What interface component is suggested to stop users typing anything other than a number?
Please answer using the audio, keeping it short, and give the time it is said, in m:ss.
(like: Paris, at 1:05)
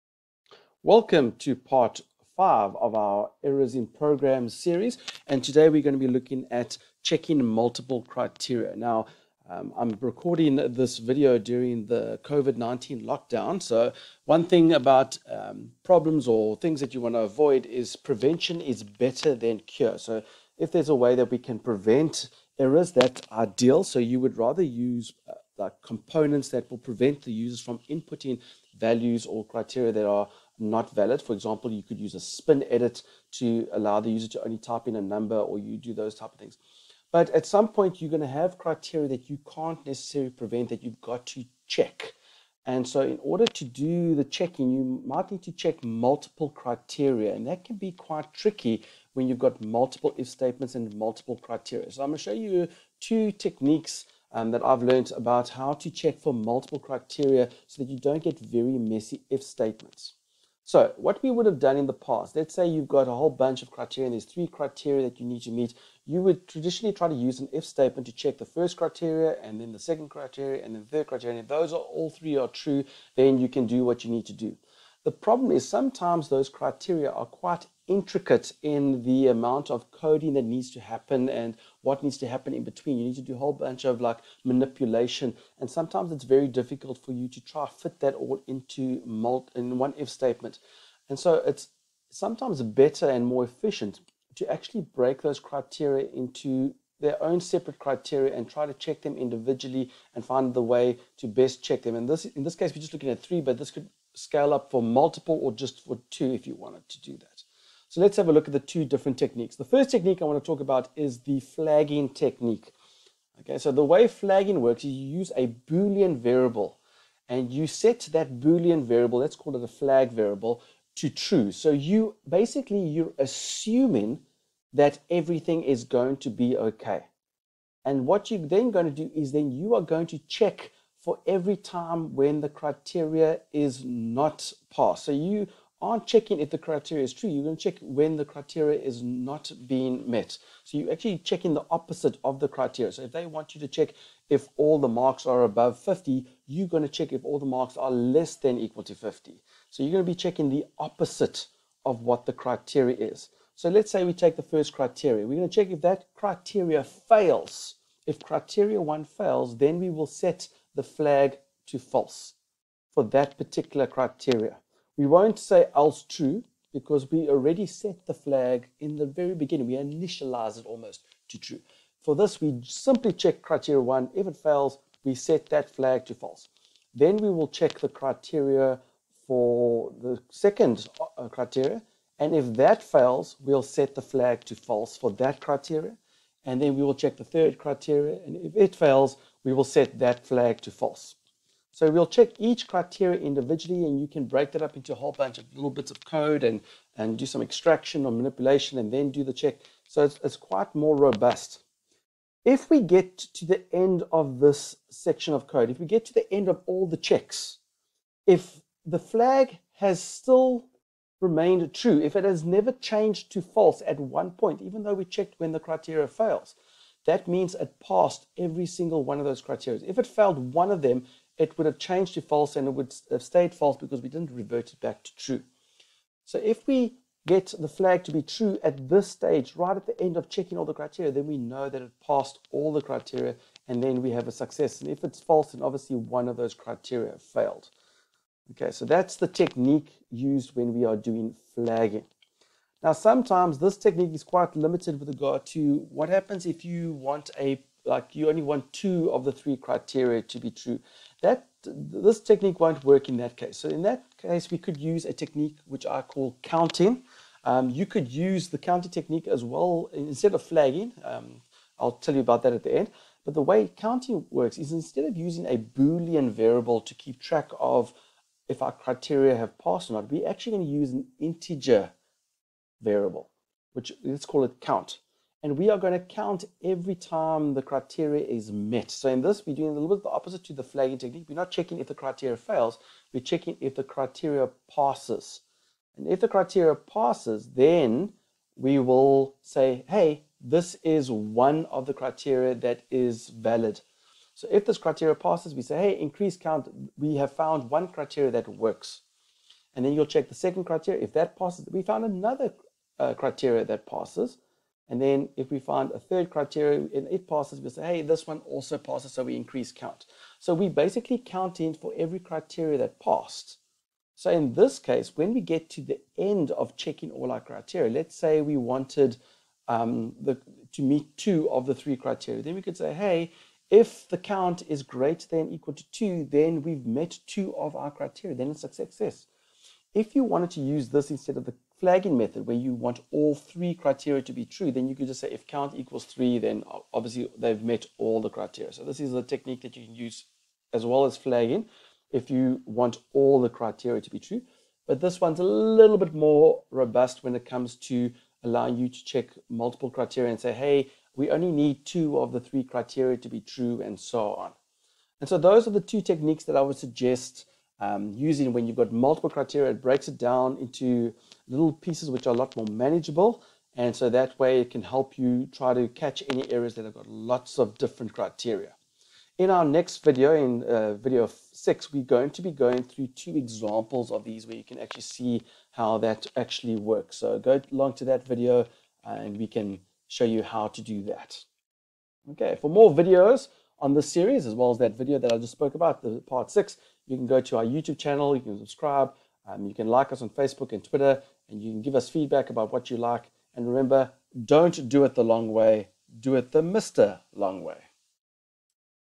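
spin edit, at 0:32.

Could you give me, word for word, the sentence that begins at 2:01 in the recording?
So you basically you're assuming that everything is going to be okay.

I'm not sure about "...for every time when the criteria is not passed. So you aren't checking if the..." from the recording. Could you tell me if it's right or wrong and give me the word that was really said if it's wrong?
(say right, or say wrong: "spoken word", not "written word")
right.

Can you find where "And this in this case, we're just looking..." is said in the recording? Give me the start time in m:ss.
1:41.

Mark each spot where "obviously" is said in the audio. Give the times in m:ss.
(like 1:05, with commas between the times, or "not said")
3:55, 5:36.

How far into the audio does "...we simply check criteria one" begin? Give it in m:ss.
2:52.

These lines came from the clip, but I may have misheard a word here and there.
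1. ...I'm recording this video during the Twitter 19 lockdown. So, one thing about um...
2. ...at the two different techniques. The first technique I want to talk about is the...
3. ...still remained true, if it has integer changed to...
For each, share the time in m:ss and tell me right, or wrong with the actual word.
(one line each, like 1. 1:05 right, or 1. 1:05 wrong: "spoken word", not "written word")
1. 0:09 wrong: "COVID", not "Twitter"
2. 1:48 right
3. 3:30 wrong: "never", not "integer".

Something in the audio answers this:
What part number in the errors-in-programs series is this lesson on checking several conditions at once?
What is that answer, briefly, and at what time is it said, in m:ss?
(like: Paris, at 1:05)
5, at 0:01.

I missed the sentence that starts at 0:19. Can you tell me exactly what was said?
So, if there's a way that we can prevent errors, that's ideal.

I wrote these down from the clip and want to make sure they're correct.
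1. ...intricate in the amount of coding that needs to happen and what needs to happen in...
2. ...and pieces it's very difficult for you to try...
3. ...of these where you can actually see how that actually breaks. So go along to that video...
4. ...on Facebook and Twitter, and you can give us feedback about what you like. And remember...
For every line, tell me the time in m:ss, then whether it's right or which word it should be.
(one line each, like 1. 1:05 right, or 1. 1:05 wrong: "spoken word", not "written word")
1. 1:17 right
2. 1:25 wrong: "sometimes", not "pieces"
3. 6:14 wrong: "works", not "breaks"
4. 6:30 right.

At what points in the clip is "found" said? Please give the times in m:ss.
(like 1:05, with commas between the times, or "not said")
4:57, 5:01.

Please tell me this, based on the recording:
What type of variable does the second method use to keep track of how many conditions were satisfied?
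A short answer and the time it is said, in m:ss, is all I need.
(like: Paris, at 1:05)
integer variable, at 4:31.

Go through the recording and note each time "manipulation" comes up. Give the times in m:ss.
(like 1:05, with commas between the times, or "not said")
1:24, 3:18.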